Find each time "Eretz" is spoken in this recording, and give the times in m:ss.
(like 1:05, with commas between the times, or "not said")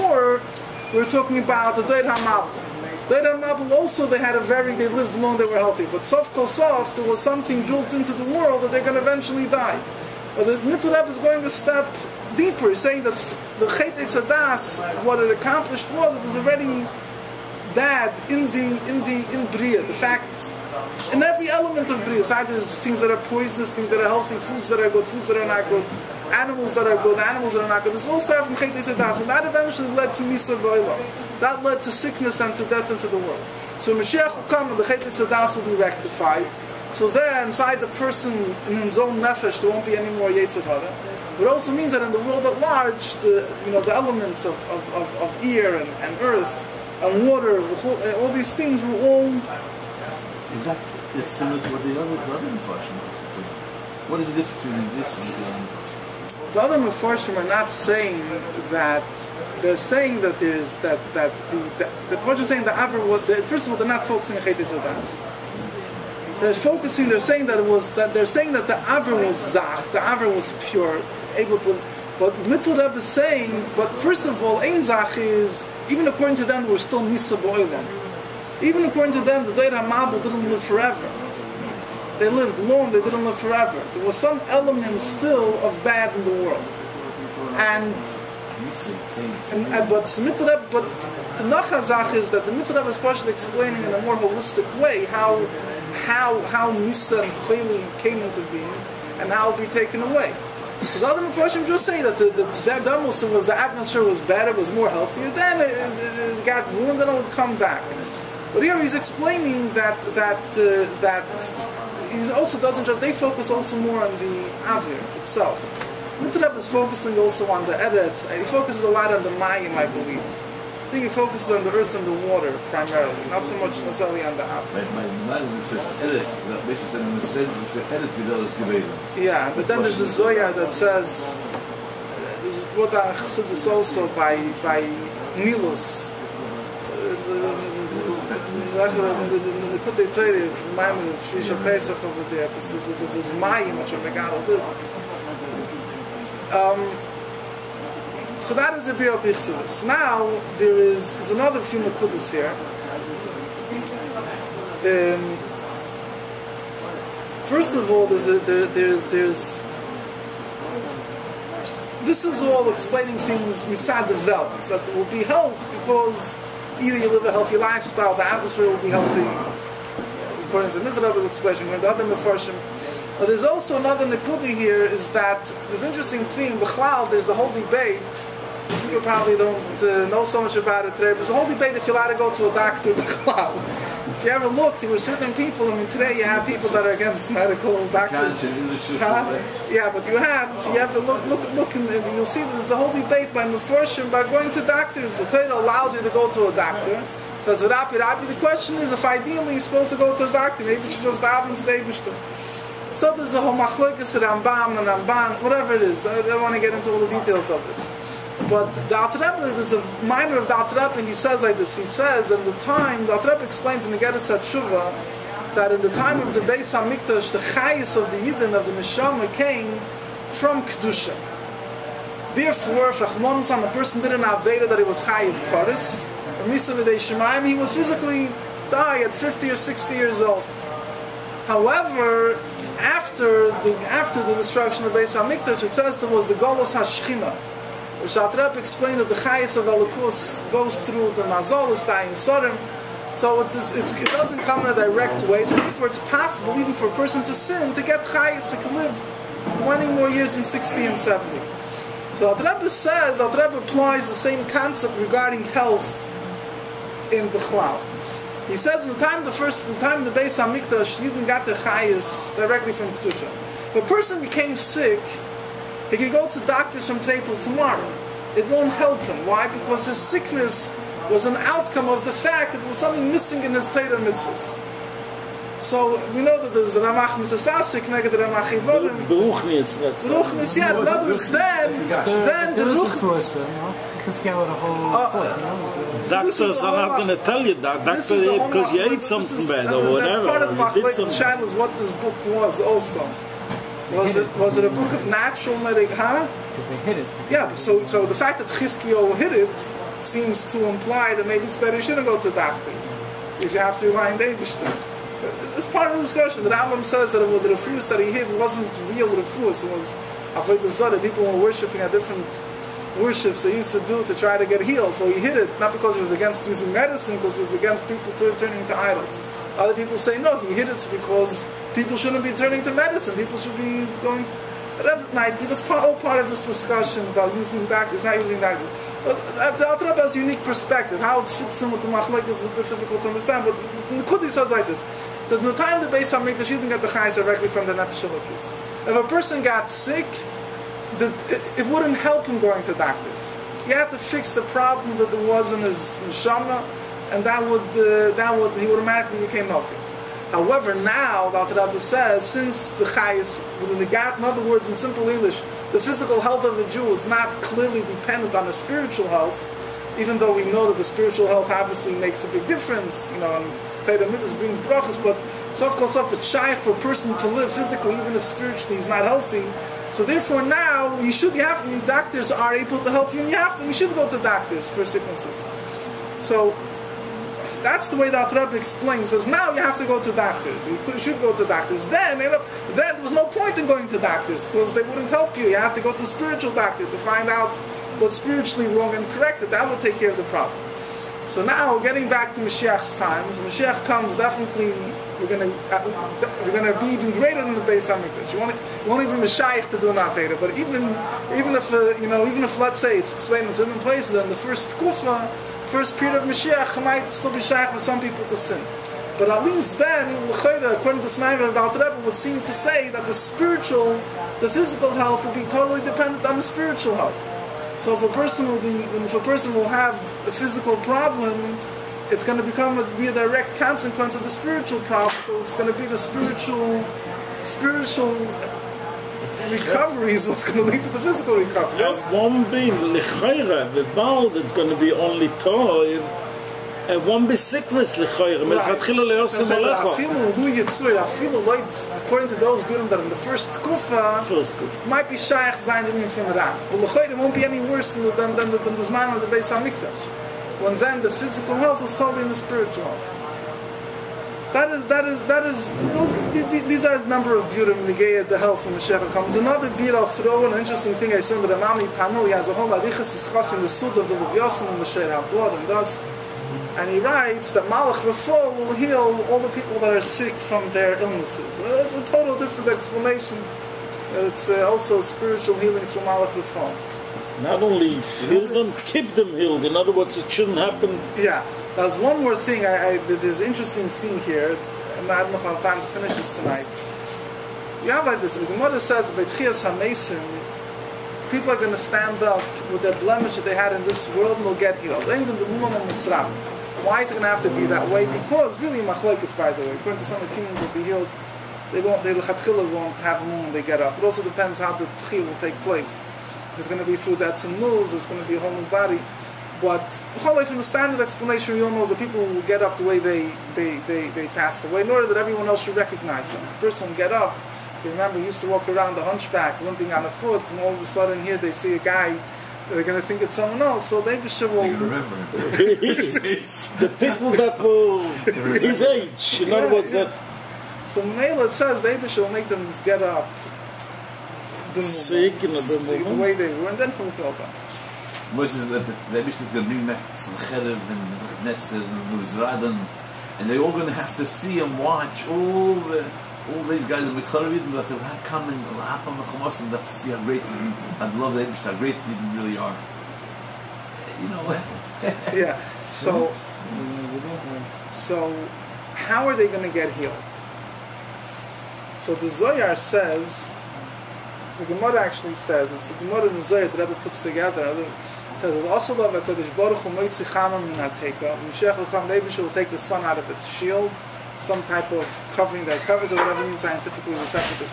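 1:57, 2:05.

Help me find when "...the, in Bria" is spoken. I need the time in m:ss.
0:19.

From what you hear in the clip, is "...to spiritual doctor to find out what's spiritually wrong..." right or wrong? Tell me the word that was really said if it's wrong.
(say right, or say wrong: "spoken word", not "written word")
right.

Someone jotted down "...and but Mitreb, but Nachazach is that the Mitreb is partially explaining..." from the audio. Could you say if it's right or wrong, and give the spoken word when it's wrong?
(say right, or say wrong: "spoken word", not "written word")
right.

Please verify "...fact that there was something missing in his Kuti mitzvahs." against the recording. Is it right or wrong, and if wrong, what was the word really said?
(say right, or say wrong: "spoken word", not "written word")
wrong: "Torah", not "Kuti".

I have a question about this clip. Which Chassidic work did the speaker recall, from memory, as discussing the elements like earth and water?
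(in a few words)
Likutei Torah.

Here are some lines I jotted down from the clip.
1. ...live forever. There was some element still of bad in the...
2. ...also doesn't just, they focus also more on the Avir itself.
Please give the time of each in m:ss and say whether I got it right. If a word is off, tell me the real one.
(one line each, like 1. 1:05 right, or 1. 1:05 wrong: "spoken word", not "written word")
1. 1:23 right
2. 1:52 right.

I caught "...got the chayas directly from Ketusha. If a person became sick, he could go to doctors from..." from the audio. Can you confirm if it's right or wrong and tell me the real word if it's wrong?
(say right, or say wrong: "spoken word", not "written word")
right.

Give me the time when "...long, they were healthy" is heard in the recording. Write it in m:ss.
0:05.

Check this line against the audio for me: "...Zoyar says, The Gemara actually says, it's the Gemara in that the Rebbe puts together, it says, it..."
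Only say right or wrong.
right.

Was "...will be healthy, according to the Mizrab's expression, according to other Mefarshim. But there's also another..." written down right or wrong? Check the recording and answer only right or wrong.
right.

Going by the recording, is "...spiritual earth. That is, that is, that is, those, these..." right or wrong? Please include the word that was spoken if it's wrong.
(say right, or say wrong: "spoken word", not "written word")
wrong: "health", not "earth".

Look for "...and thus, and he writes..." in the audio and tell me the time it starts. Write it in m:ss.
7:45.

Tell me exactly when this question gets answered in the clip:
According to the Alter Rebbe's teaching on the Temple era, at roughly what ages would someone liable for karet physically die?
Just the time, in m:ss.
3:49.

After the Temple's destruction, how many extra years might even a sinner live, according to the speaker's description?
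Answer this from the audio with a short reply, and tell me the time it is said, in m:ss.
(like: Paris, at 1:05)
20, at 4:09.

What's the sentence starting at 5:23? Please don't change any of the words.
People should be going, whatever might be.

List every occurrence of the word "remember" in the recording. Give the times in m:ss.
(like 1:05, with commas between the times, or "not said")
8:37, 8:44.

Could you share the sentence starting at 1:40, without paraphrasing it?
So the other Mepharshim just say that the, the, was the atmosphere was better, was more healthier.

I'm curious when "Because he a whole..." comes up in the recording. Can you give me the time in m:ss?
4:43.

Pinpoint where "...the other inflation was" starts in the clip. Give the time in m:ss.
0:52.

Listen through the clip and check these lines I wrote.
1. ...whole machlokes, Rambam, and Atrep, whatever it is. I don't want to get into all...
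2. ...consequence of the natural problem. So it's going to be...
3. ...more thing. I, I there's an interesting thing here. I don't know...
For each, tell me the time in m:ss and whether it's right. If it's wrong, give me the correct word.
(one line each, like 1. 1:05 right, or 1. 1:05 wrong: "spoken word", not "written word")
1. 3:23 wrong: "Ramban", not "Atrep"
2. 7:03 wrong: "spiritual", not "natural"
3. 8:02 right.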